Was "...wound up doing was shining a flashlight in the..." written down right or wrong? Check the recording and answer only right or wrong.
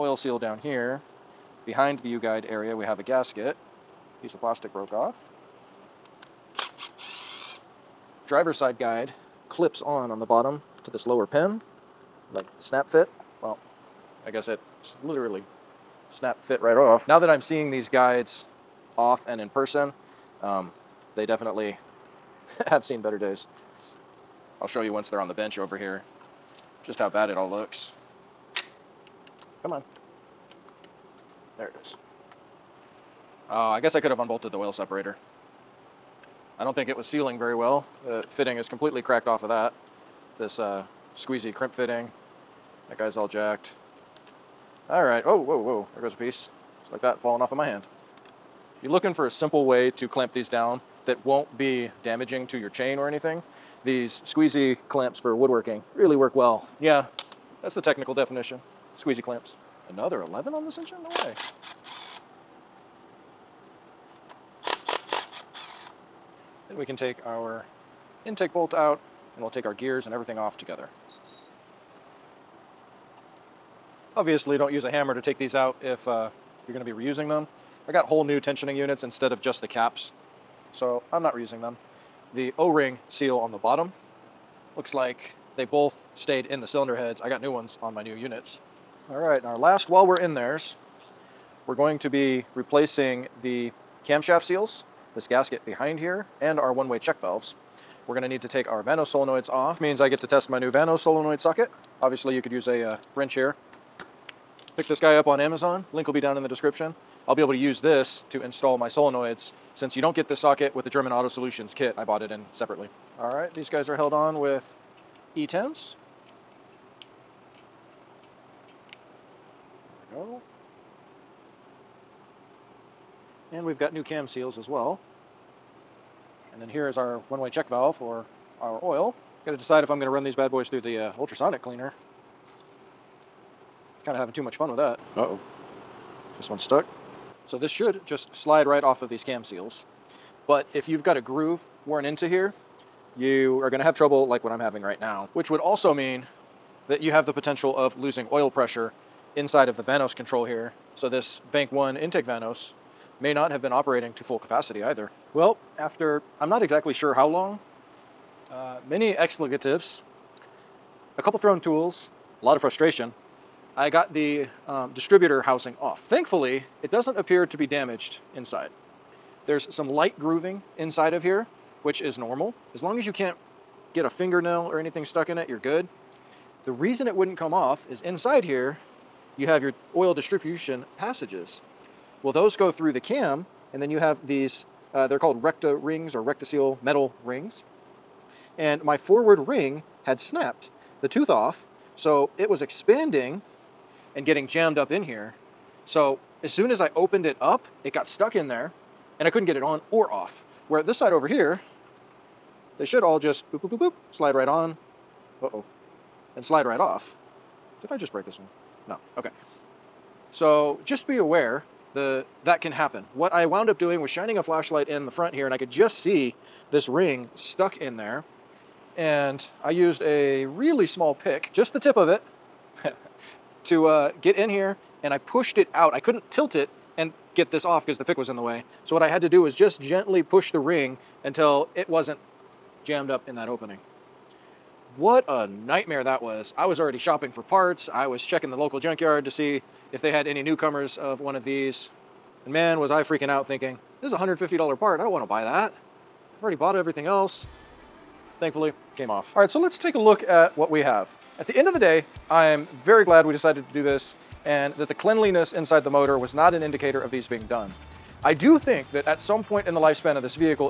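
right.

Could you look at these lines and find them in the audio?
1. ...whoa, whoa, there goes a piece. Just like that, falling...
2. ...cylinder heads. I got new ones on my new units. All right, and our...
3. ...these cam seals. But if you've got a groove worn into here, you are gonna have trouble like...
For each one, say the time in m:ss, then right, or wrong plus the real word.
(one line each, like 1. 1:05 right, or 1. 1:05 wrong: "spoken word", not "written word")
1. 0:45 right
2. 1:26 right
3. 2:19 right.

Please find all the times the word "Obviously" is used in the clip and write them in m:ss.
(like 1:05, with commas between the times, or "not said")
1:14, 1:42.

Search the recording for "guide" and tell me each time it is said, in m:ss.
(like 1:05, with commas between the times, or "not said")
0:02, 0:08, 0:17.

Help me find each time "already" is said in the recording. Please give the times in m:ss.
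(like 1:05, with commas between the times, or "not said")
3:56, 4:06.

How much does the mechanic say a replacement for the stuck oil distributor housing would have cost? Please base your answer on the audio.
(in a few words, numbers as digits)
$150.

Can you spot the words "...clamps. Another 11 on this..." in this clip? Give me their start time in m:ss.
0:59.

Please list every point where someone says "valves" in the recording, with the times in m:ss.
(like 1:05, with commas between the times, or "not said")
1:37, 2:07.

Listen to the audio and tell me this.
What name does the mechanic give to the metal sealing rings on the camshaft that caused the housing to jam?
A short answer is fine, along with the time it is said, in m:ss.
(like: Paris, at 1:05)
RectaSeal, at 3:06.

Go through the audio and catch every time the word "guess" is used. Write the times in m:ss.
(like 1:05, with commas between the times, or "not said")
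0:14, 0:33.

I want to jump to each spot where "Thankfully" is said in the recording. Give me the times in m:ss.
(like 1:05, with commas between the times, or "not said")
2:46, 4:08.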